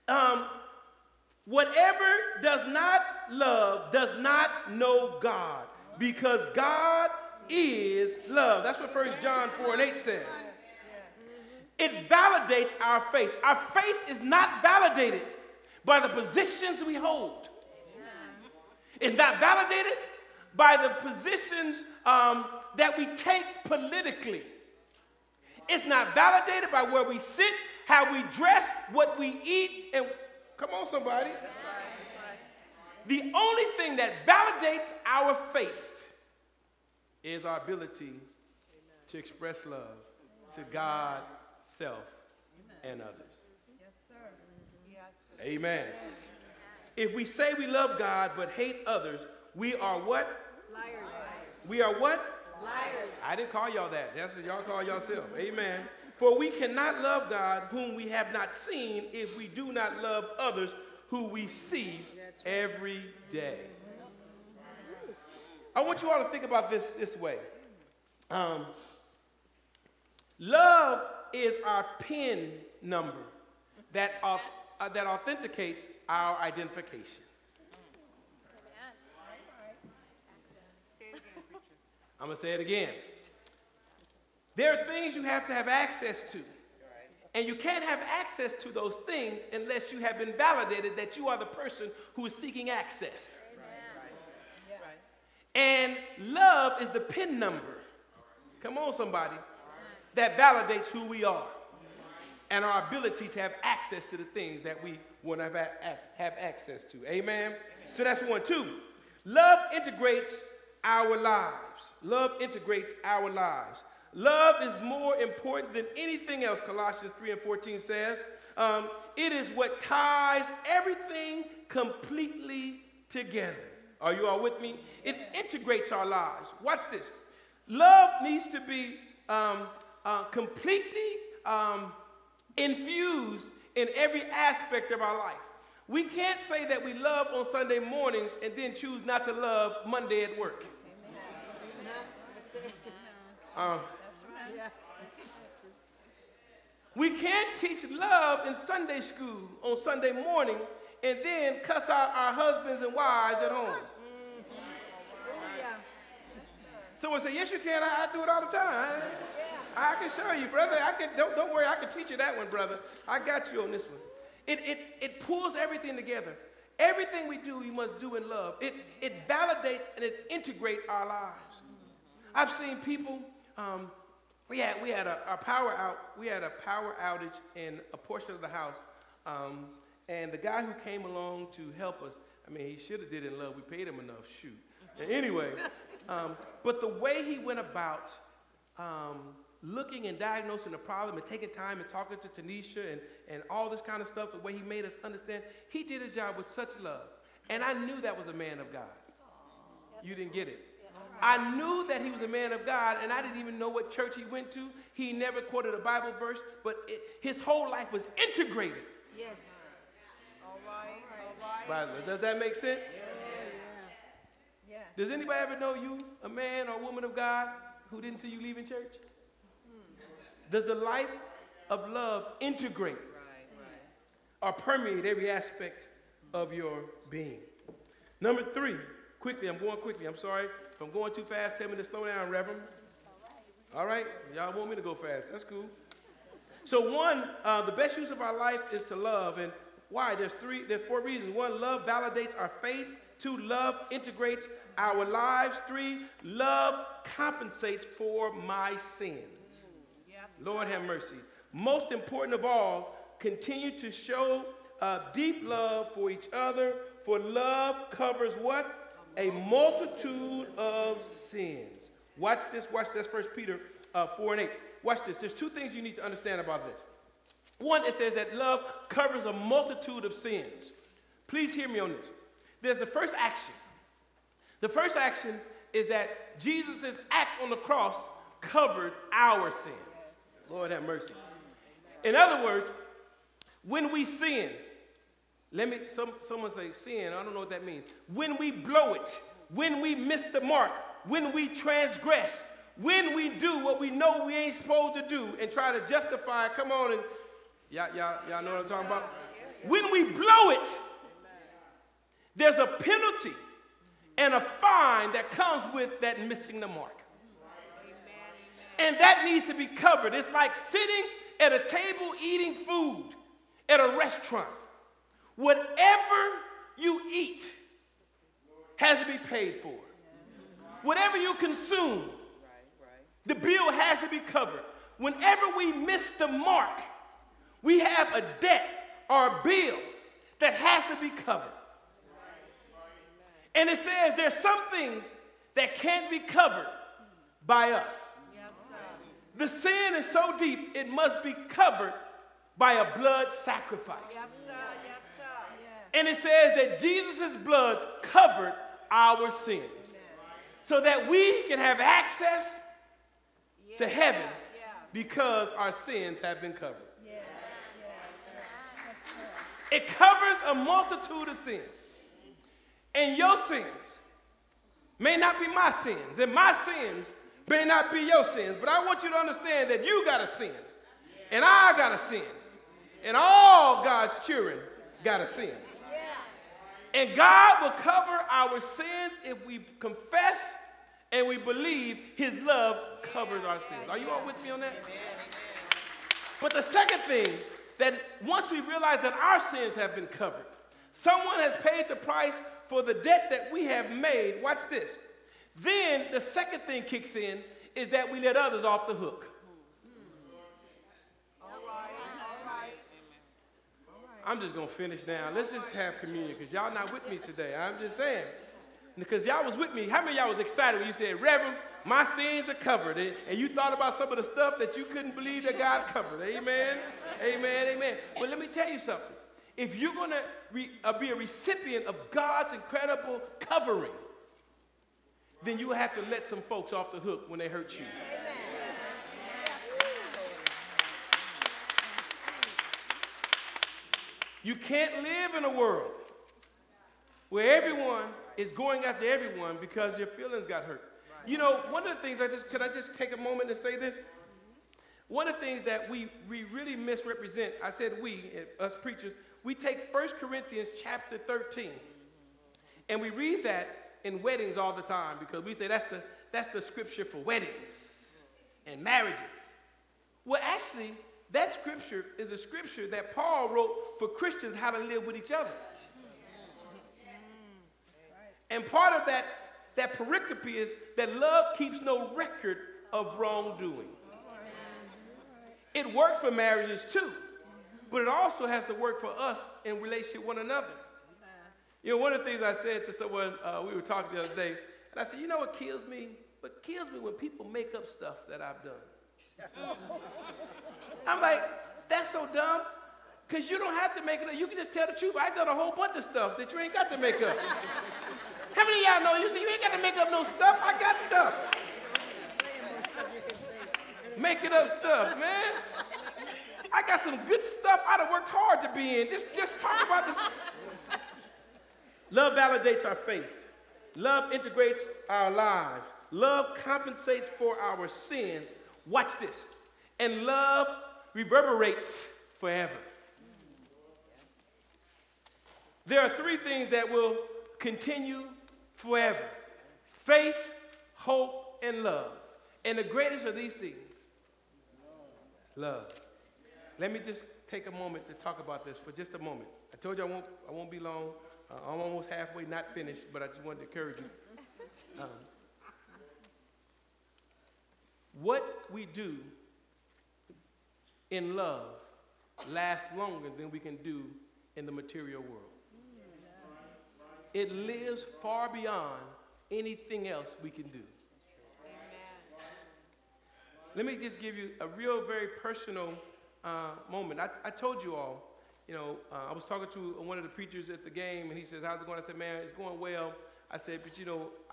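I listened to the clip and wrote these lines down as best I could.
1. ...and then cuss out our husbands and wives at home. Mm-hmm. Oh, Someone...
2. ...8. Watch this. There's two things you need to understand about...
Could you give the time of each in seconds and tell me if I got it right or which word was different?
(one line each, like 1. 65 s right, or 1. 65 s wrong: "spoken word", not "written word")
1. 151 s right
2. 264 s right.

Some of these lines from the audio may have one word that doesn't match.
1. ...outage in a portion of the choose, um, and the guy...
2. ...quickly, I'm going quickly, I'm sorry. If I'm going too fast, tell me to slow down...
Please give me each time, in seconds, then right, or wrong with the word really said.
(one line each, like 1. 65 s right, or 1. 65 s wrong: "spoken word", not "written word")
1. 177 s wrong: "house", not "choose"
2. 229 s right.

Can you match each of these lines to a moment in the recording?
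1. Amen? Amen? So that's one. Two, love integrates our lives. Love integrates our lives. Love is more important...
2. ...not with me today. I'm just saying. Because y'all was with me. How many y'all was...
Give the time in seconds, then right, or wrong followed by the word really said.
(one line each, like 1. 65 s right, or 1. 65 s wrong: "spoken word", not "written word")
1. 107 s right
2. 406 s right.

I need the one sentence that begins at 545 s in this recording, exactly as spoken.
Um, what we do in love lasts longer than we can do in the material world.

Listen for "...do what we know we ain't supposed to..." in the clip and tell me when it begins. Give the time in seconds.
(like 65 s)
293 s.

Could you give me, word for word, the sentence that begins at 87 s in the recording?
And you can't have access to those things unless you have been validated that you are the person who is seeking access.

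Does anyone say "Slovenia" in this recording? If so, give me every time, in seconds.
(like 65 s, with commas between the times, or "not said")
not said.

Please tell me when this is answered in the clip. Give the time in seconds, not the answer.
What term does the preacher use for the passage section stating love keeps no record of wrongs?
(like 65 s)
469 s.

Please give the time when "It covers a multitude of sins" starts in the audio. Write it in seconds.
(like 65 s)
359 s.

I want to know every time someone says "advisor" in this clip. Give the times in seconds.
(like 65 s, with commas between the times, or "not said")
not said.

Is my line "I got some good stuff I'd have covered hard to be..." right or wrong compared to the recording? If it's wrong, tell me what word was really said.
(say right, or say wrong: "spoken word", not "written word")
wrong: "worked", not "covered".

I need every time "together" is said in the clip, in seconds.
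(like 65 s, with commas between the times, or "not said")
123 s, 165 s.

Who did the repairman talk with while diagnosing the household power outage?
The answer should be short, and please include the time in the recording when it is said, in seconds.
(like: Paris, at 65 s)
Tanisha, at 192 s.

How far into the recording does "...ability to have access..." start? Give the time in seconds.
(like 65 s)
102 s.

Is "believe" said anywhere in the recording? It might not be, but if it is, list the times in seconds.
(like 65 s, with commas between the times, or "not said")
381 s, 415 s.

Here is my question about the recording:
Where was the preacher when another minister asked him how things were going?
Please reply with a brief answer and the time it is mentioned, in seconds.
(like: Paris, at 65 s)
At the game, at 570 s.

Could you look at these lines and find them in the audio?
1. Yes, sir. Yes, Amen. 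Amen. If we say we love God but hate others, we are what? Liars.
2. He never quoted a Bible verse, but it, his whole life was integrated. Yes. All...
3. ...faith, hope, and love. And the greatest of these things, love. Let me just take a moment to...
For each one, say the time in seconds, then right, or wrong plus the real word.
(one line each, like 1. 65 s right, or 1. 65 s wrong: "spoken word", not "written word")
1. 43 s right
2. 204 s right
3. 529 s right.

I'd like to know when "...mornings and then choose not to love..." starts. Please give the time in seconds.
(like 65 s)
137 s.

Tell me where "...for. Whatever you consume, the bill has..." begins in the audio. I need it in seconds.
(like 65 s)
319 s.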